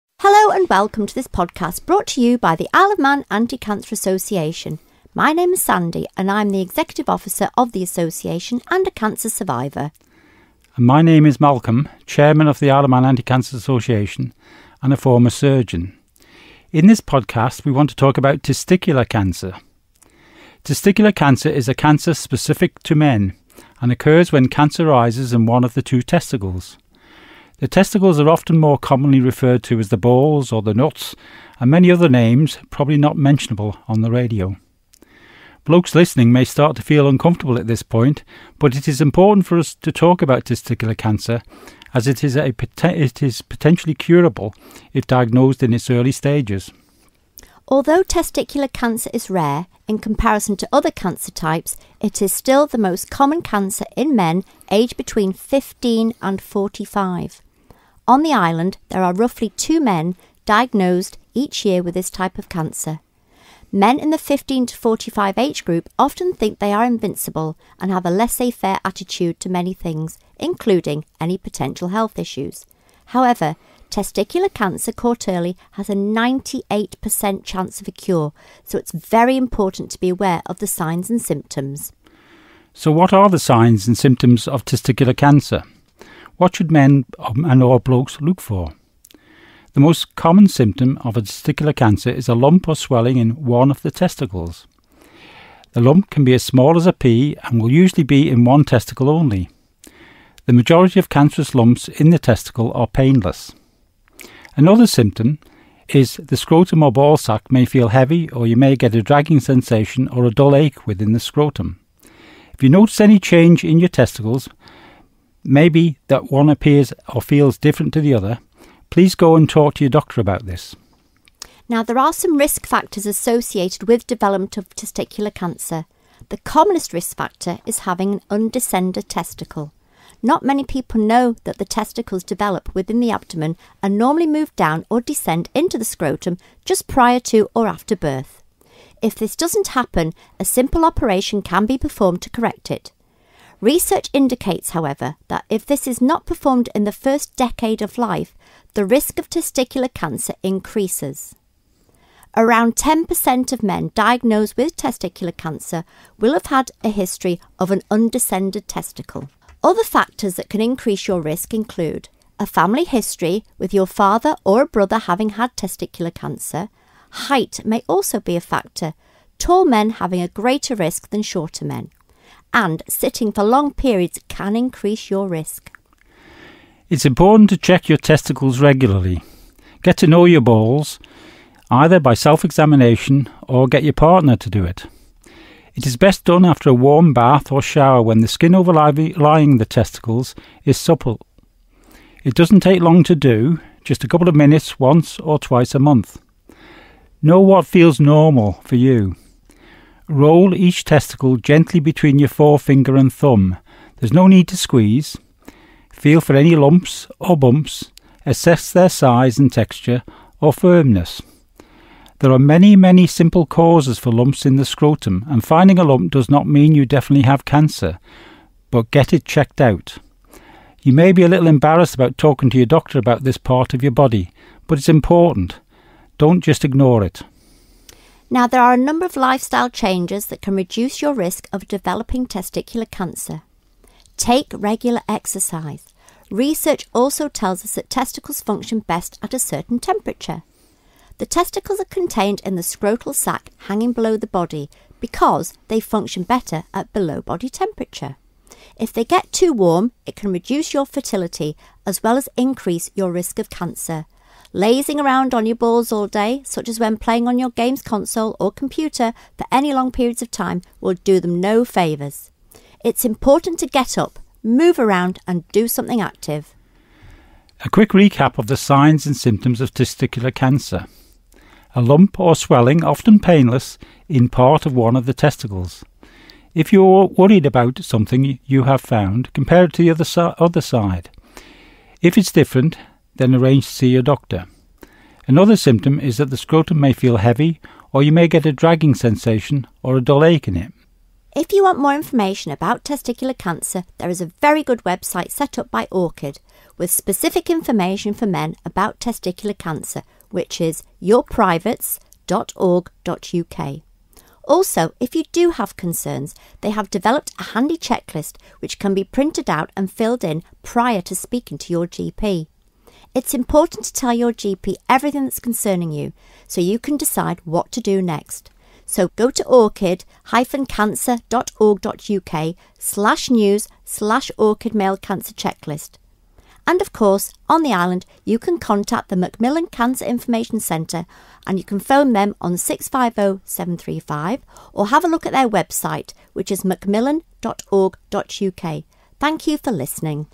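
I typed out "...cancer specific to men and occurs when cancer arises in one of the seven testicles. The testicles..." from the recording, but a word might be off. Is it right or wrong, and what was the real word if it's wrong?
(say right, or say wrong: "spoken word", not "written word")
wrong: "two", not "seven".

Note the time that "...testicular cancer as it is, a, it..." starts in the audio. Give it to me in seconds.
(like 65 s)
40 s.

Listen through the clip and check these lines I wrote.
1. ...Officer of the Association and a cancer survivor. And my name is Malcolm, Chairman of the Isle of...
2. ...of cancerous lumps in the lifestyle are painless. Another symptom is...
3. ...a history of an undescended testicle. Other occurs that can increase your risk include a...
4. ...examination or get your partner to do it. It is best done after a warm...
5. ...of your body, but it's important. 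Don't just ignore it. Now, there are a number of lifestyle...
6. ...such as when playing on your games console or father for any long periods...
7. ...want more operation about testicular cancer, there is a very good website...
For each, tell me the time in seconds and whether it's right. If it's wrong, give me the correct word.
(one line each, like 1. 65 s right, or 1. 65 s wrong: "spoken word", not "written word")
1. 7 s right
2. 100 s wrong: "testicle", not "lifestyle"
3. 156 s wrong: "factors", not "occurs"
4. 182 s right
5. 223 s right
6. 256 s wrong: "computer", not "father"
7. 291 s wrong: "information", not "operation".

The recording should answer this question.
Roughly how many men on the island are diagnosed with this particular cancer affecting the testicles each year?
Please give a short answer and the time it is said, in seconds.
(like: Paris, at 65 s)
2, at 59 s.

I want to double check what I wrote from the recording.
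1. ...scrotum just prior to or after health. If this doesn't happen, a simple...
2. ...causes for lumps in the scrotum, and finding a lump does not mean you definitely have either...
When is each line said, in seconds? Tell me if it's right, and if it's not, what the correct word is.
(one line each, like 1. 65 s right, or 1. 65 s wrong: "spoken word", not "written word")
1. 135 s wrong: "birth", not "health"
2. 213 s wrong: "cancer", not "either".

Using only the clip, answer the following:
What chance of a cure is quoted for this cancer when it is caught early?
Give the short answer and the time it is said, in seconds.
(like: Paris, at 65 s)
98%, at 75 s.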